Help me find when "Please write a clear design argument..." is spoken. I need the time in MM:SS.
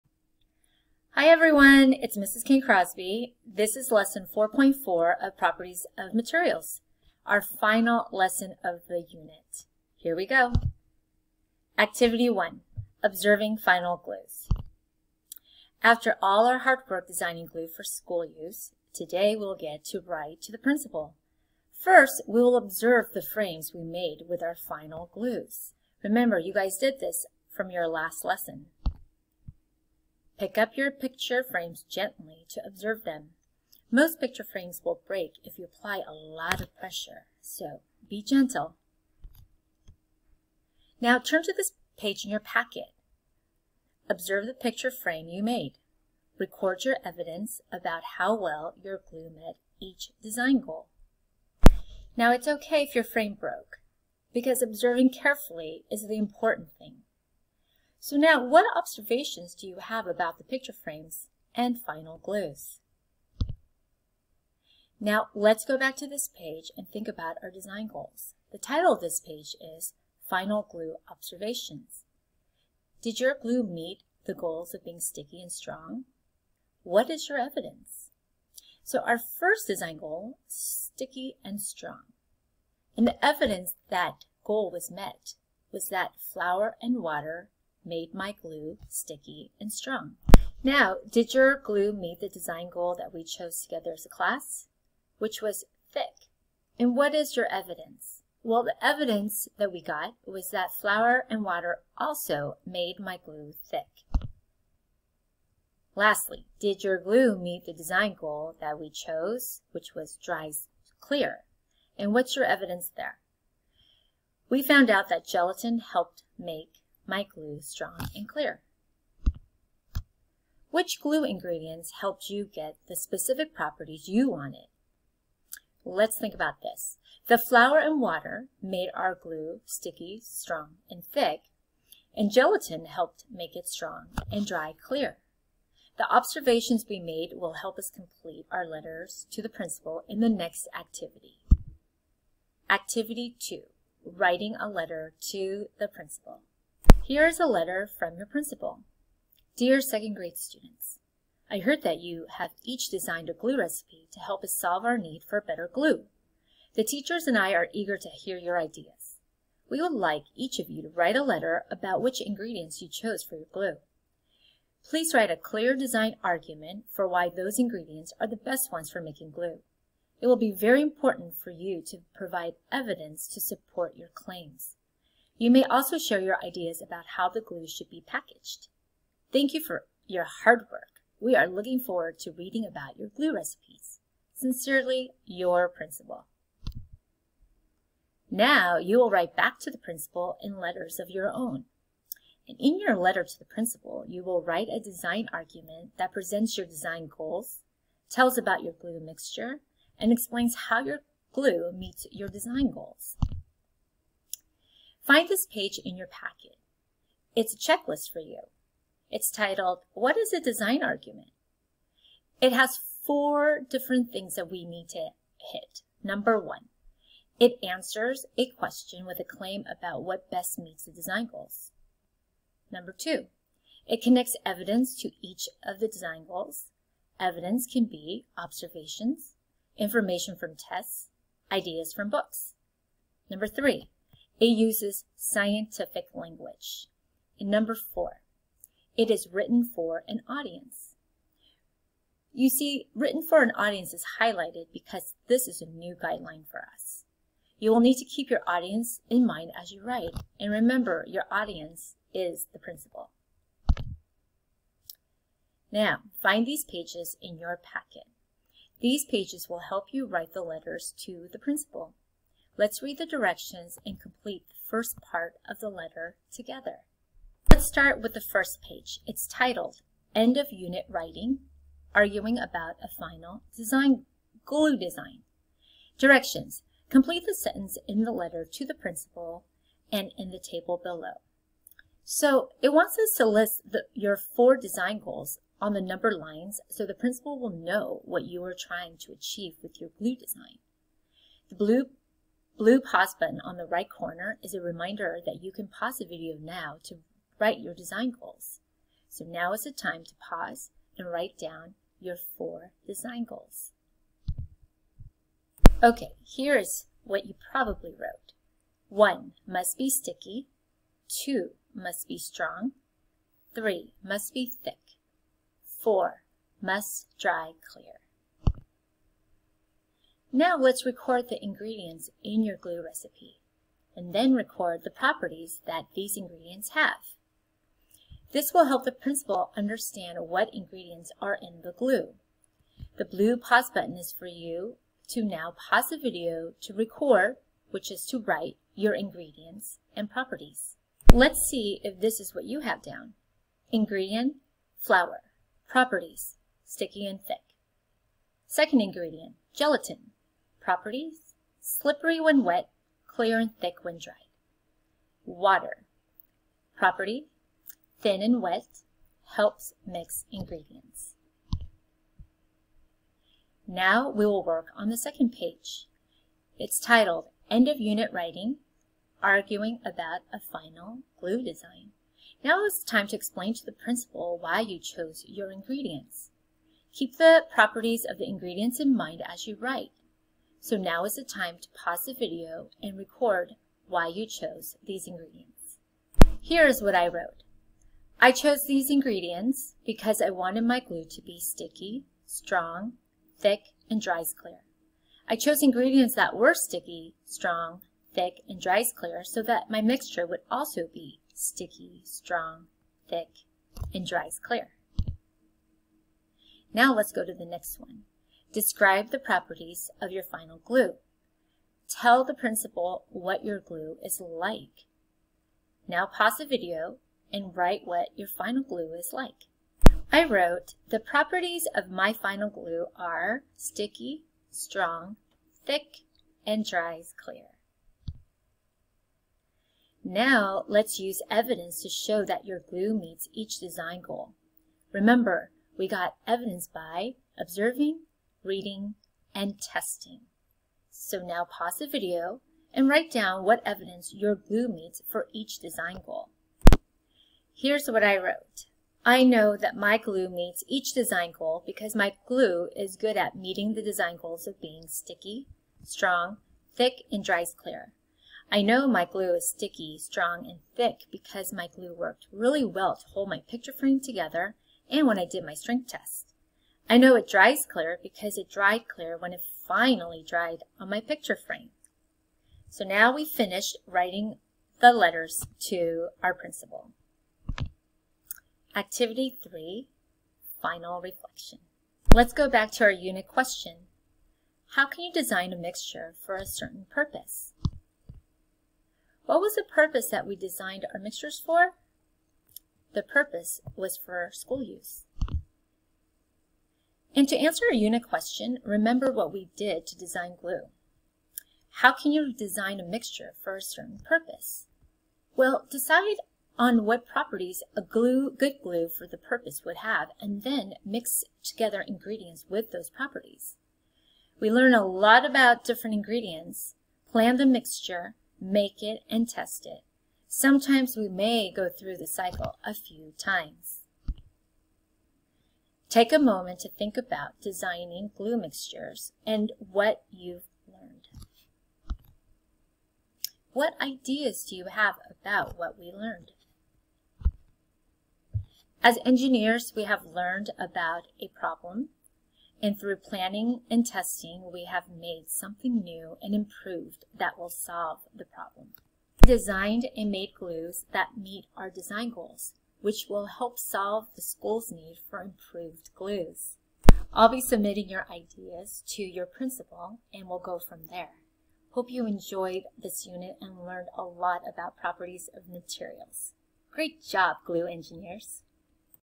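02:44.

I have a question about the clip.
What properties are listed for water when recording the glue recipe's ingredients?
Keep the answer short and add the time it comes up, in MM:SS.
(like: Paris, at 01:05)
thin and wet, at 05:57.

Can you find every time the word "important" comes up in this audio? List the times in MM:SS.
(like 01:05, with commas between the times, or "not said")
00:56, 02:50.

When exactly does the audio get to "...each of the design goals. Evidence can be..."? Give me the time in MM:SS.
03:45.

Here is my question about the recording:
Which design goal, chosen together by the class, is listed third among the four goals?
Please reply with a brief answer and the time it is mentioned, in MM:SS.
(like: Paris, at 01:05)
must be thick, at 05:13.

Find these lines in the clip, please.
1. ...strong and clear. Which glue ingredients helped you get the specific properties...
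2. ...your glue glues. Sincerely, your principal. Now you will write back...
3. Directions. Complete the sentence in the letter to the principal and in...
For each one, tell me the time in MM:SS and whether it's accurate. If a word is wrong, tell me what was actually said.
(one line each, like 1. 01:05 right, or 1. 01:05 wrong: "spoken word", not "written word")
1. 01:57 right
2. 03:02 wrong: "recipes", not "glues"
3. 04:35 right.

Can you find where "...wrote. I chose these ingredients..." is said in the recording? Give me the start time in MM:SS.
06:27.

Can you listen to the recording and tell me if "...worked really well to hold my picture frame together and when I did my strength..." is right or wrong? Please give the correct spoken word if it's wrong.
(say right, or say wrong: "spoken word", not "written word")
right.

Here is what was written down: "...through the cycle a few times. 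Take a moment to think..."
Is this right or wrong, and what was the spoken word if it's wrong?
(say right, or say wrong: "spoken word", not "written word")
right.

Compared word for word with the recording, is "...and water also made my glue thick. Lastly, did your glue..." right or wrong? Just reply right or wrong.
right.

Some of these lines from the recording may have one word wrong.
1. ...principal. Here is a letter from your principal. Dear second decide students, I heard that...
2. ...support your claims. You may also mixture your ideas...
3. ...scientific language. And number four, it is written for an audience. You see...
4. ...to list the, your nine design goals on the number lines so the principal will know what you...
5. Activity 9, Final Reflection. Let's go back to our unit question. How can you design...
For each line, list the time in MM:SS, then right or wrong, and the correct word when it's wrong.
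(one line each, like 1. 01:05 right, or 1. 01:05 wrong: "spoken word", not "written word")
1. 02:25 wrong: "grade", not "decide"
2. 02:53 wrong: "share", not "mixture"
3. 03:55 right
4. 04:43 wrong: "four", not "nine"
5. 07:58 wrong: "3", not "9".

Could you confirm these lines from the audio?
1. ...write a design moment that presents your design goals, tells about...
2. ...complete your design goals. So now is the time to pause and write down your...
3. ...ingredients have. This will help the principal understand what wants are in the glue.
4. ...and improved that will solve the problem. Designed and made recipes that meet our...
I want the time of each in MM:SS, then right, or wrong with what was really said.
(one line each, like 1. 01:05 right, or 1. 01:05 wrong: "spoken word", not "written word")
1. 03:14 wrong: "argument", not "moment"
2. 04:57 wrong: "write", not "complete"
3. 05:26 wrong: "ingredients", not "wants"
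4. 09:06 wrong: "glues", not "recipes".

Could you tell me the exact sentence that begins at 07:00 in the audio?
I wrote, the properties of my final glue are sticky, strong, thick, and dries clear.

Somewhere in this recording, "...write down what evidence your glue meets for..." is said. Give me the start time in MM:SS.
07:22.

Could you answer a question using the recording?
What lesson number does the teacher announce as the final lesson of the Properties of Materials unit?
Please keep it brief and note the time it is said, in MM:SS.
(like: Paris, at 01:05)
4.4, at 00:03.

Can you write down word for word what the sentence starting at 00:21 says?
First, we will observe the frames we made with our final glues.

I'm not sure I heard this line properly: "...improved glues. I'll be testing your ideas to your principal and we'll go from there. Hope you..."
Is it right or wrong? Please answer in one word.
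wrong.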